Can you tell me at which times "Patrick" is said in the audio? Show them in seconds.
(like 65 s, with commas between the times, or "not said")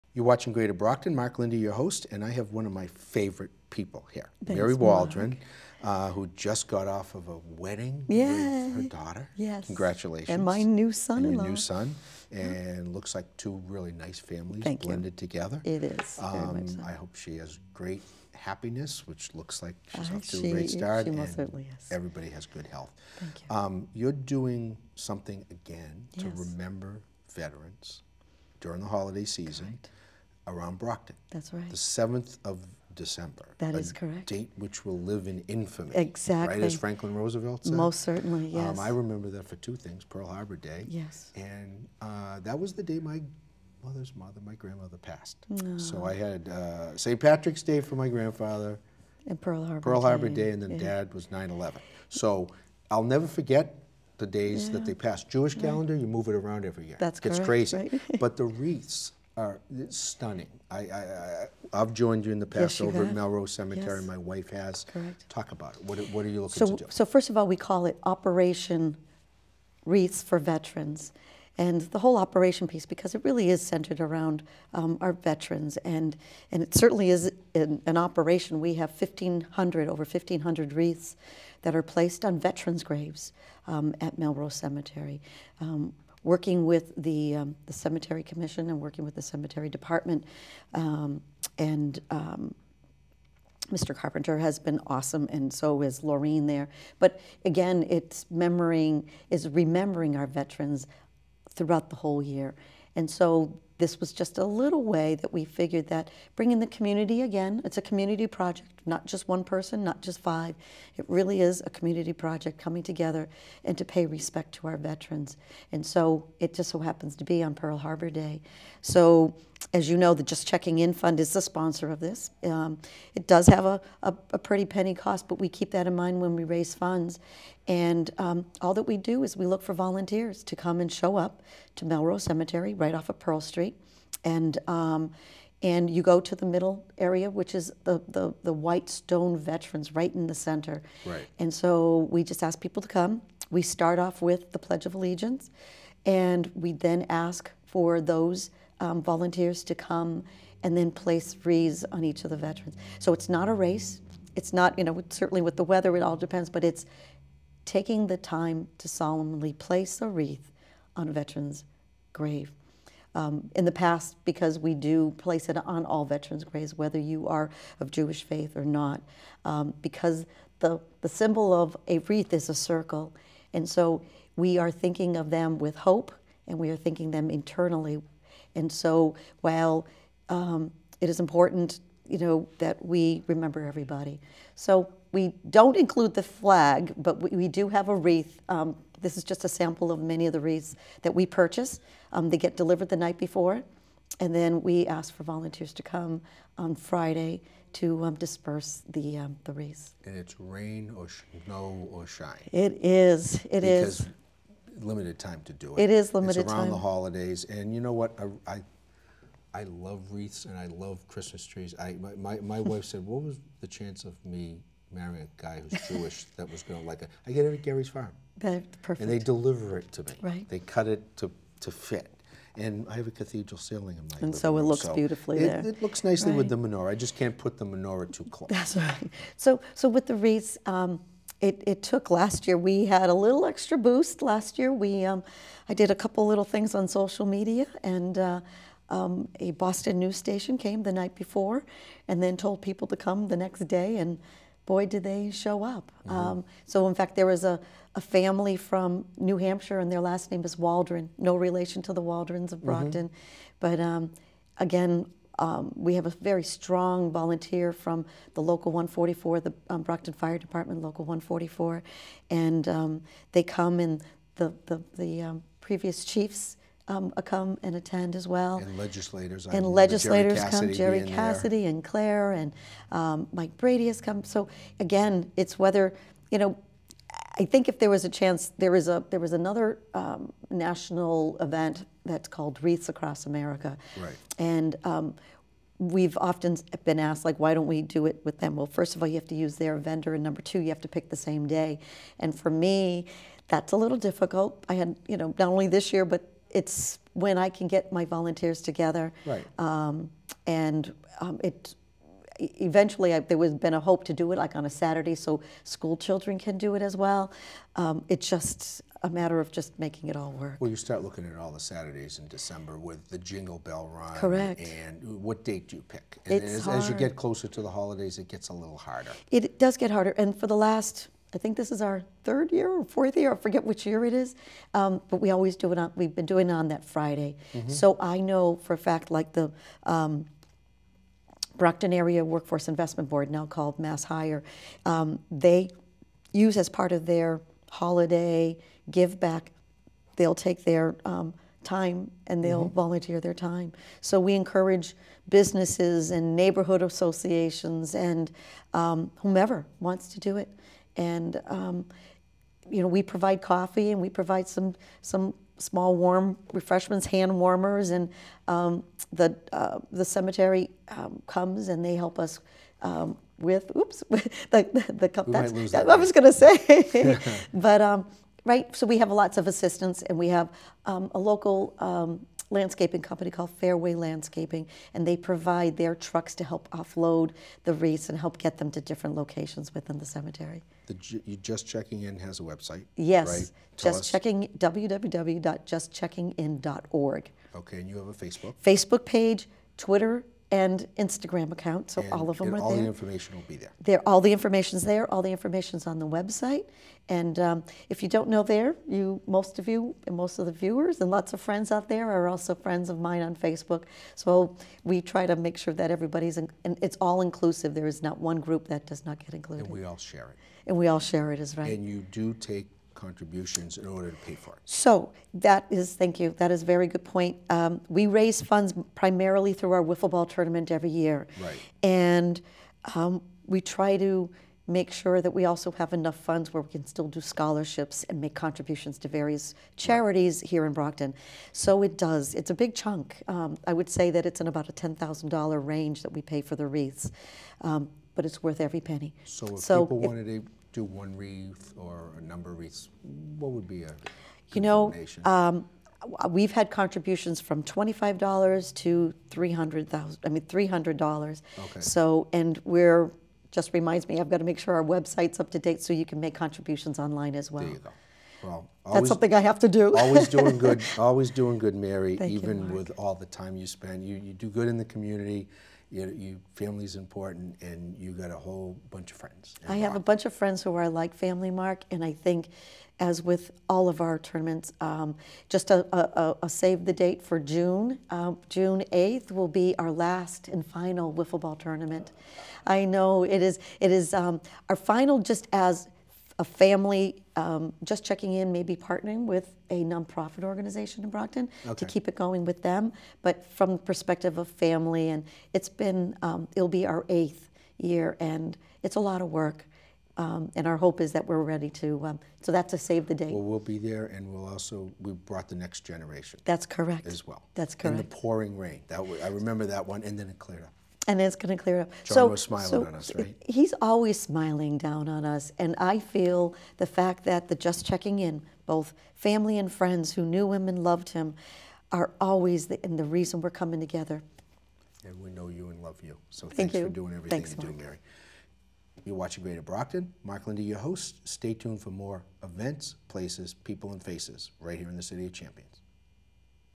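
47 s.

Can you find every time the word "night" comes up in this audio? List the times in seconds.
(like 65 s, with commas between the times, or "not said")
192 s, 240 s.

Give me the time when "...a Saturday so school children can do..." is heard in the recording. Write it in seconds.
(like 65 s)
304 s.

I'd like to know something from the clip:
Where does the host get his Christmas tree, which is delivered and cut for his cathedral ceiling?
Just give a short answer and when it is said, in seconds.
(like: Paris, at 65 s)
Gary's Farm, at 217 s.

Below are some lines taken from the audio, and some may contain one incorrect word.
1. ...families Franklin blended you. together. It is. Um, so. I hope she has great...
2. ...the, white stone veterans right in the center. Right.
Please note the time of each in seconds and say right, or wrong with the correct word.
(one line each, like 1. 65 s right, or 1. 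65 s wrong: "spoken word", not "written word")
1. 14 s wrong: "Thank", not "Franklin"
2. 138 s right.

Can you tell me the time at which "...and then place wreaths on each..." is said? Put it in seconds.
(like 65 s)
150 s.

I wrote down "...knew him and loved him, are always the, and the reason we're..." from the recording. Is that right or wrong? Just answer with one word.
right.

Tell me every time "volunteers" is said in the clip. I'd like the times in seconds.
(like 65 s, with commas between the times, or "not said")
129 s, 149 s, 195 s, 257 s, 298 s, 342 s.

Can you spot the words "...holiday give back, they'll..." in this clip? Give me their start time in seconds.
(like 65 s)
337 s.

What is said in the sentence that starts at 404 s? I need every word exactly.
So we try to make sure that everybody's in, and it's all inclusive.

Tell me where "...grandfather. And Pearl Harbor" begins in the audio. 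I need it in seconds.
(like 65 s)
48 s.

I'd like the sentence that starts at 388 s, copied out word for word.
Facebook page, Twitter, and Instagram account, so and, all of them are all there.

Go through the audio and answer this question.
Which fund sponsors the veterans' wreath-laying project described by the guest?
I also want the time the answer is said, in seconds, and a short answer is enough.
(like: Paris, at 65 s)
Just Checking In Fund, at 120 s.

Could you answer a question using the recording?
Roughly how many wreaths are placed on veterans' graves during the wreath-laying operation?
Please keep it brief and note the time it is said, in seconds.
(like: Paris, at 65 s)
over 1,500, at 79 s.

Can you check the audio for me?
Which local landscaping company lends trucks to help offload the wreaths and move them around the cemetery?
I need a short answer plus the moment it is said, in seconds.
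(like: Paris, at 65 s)
Fairway Landscaping, at 373 s.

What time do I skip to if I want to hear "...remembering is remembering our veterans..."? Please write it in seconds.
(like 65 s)
98 s.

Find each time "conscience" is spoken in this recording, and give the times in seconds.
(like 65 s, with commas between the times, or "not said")
not said.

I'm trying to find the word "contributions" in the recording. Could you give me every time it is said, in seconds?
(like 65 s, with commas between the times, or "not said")
412 s, 428 s, 446 s, 456 s.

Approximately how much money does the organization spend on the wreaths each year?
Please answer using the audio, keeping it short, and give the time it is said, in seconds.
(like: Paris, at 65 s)
$10,000, at 434 s.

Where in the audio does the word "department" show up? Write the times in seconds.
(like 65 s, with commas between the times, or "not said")
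89 s, 260 s.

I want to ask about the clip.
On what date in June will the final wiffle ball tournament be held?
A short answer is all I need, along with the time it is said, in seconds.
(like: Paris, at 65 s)
June 8th, at 478 s.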